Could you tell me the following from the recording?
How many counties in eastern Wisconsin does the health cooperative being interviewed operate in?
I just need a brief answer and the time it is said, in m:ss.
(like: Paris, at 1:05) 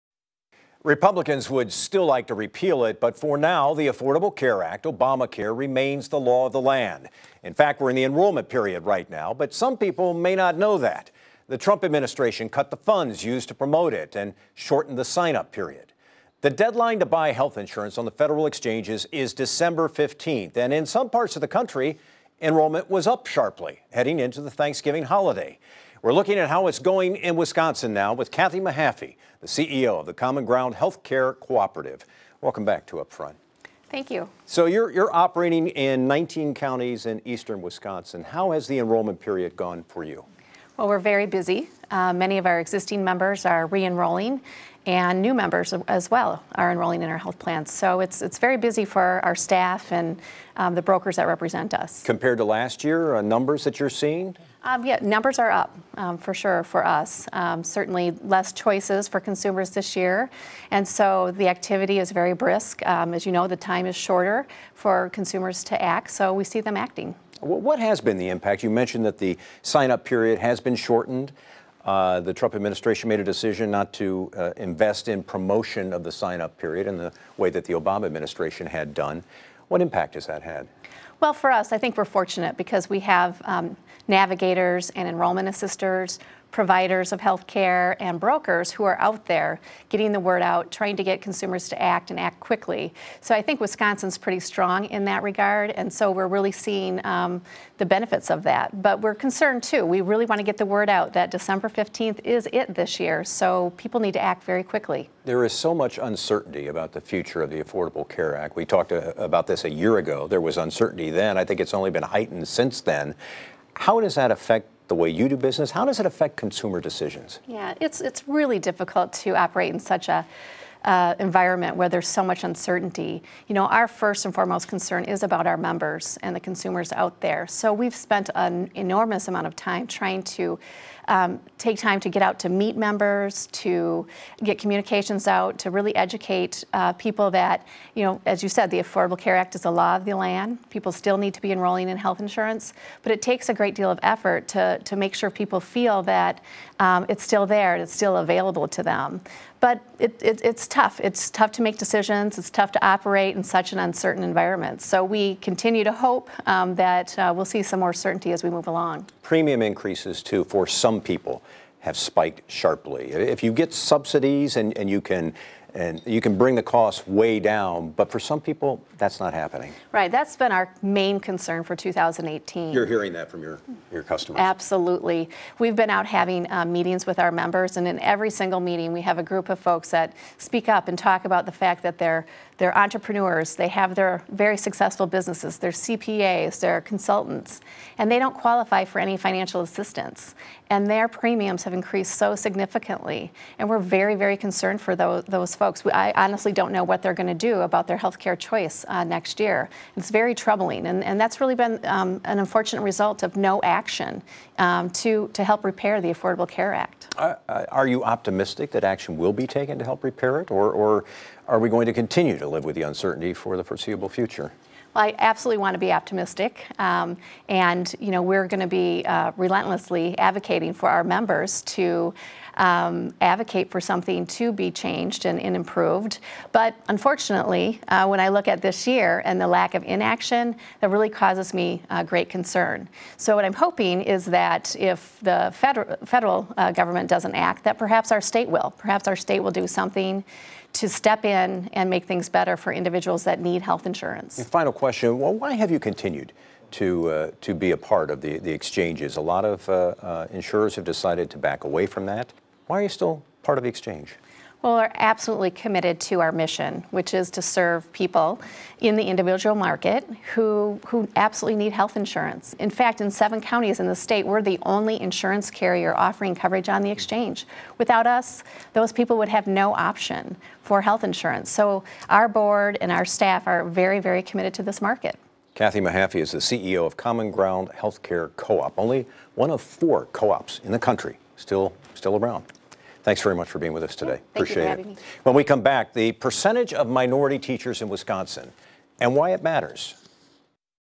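19, at 0:36.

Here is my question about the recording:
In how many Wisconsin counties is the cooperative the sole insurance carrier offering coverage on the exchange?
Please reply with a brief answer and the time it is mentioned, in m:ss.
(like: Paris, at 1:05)
7, at 4:23.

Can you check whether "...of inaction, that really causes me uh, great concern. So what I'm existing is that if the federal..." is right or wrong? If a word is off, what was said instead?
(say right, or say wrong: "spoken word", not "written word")
wrong: "hoping", not "existing".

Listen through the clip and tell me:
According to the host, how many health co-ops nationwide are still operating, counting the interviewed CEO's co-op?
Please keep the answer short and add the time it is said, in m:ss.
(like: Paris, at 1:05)
4, at 4:39.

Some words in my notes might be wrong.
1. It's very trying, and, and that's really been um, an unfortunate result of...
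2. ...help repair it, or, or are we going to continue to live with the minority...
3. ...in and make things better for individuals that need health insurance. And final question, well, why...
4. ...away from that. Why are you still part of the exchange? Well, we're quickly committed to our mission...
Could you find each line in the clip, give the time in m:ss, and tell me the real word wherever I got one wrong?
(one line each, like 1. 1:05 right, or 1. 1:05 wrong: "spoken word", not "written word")
1. 3:19 wrong: "troubling", not "trying"
2. 3:29 wrong: "uncertainty", not "minority"
3. 4:01 right
4. 4:11 wrong: "absolutely", not "quickly".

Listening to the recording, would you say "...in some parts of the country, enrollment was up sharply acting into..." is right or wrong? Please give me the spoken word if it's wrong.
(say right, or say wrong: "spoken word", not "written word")
wrong: "heading", not "acting".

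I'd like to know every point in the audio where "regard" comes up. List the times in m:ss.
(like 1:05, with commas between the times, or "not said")
1:35.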